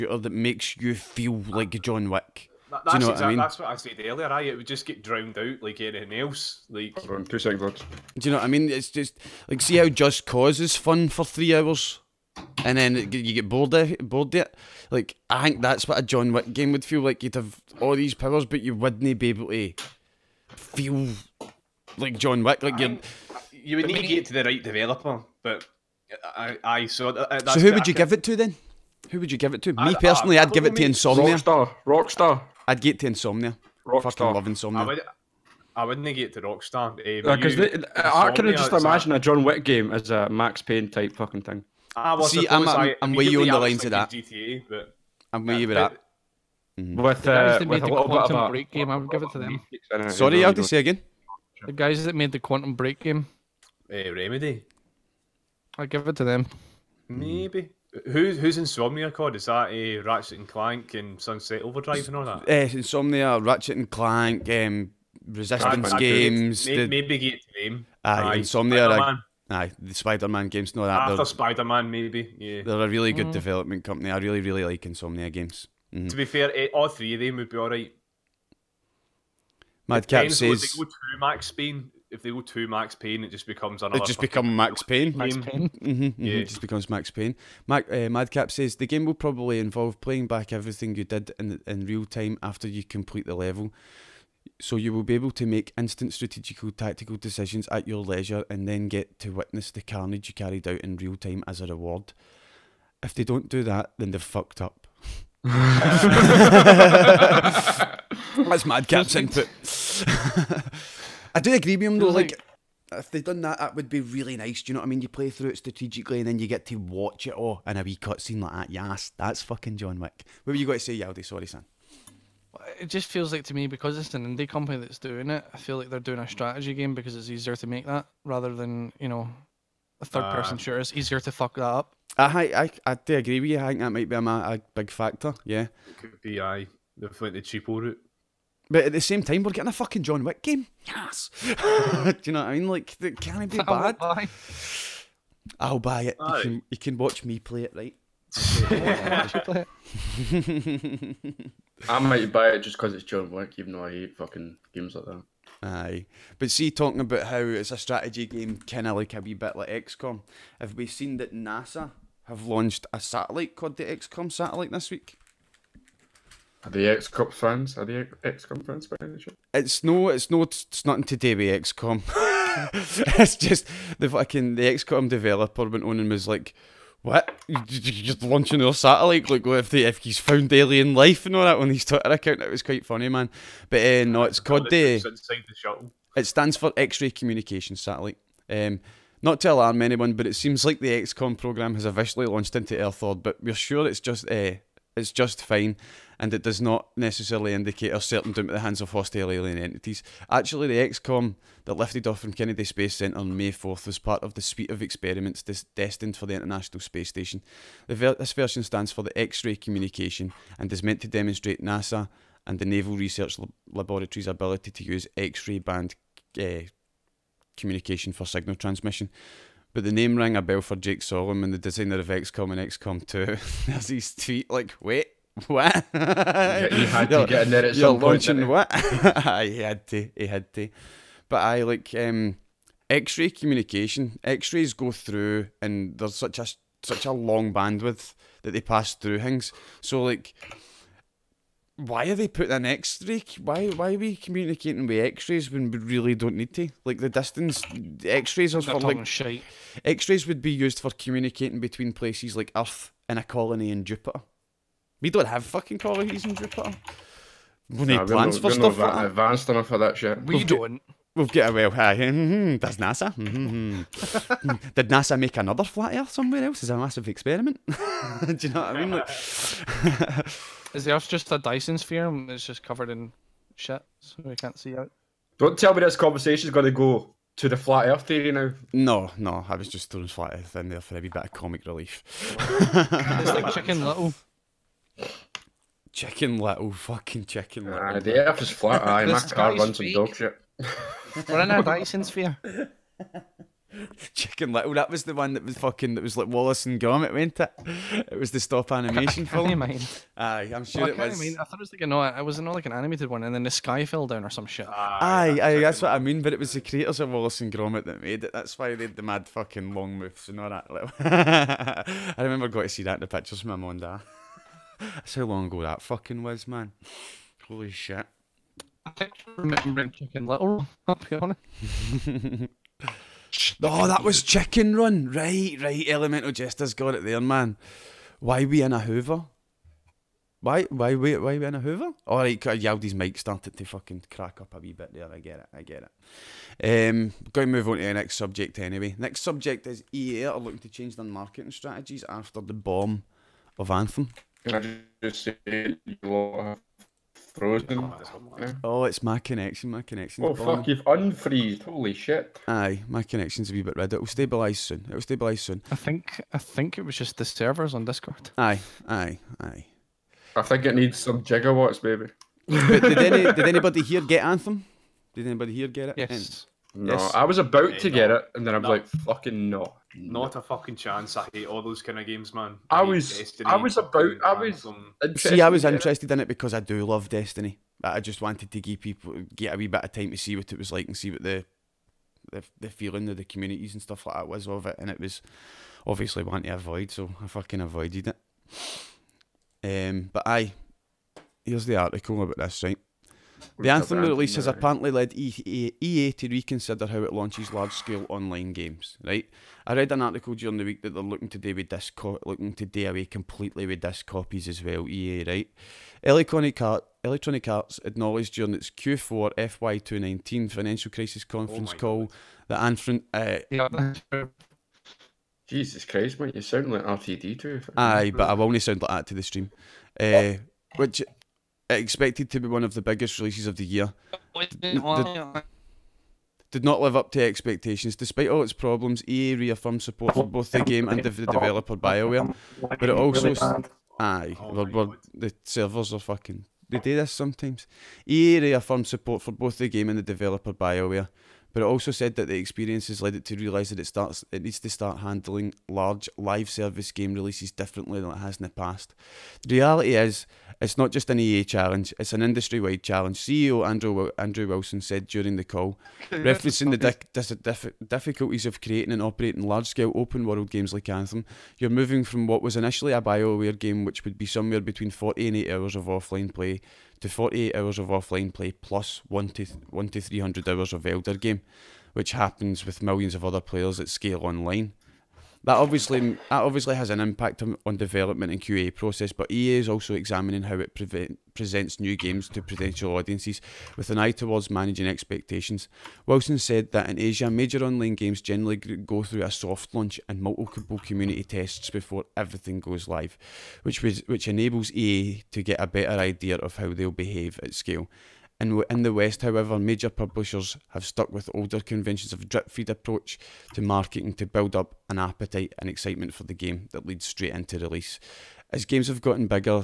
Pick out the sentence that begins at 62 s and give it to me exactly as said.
Yes, uh, Insomnia, Ratchet and Clank, um, Resistance Games.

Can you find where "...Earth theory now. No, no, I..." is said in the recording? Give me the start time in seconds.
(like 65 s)
277 s.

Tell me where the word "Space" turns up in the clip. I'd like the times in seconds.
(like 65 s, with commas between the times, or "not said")
202 s, 206 s.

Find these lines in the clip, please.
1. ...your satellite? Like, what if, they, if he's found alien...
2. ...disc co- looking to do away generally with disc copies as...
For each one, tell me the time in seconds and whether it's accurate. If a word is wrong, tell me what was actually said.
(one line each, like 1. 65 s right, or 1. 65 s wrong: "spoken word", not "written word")
1. 178 s right
2. 401 s wrong: "completely", not "generally".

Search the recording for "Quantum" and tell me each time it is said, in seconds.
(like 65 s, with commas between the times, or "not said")
47 s, 52 s.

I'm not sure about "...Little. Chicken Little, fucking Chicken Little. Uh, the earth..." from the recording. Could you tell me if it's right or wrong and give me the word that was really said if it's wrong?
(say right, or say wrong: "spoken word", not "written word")
right.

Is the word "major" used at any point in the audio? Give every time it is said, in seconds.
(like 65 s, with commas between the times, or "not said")
487 s, 499 s.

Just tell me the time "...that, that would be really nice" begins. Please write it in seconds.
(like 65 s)
113 s.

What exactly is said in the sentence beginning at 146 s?
You, can, you can watch me play it, right?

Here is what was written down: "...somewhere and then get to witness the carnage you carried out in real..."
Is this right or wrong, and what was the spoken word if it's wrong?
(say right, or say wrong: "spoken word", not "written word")
wrong: "leisure", not "somewhere".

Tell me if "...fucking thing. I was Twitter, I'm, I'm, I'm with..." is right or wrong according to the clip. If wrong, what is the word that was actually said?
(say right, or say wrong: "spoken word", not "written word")
wrong: "See", not "Twitter".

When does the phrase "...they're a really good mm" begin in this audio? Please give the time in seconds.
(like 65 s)
72 s.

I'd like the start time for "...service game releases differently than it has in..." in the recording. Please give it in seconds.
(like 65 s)
446 s.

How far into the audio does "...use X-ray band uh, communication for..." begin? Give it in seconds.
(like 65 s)
214 s.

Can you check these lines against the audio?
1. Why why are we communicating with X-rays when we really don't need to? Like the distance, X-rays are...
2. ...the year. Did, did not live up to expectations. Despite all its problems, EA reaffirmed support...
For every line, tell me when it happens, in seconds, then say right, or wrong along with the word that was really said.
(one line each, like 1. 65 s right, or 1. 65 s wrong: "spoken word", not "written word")
1. 243 s right
2. 423 s right.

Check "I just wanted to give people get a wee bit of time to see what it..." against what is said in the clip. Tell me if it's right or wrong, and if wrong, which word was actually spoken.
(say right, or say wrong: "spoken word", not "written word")
right.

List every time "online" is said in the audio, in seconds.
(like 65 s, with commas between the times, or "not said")
398 s, 474 s, 487 s.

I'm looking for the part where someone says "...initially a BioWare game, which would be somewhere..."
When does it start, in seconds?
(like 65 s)
462 s.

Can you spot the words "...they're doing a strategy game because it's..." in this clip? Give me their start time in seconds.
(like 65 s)
125 s.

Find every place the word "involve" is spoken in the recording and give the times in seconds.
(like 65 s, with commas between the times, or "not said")
89 s.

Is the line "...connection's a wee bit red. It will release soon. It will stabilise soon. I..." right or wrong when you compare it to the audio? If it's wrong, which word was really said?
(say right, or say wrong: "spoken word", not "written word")
wrong: "stabilise", not "release".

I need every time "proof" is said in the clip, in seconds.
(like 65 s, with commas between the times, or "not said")
not said.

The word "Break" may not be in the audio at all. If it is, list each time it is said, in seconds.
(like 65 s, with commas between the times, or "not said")
48 s, 52 s.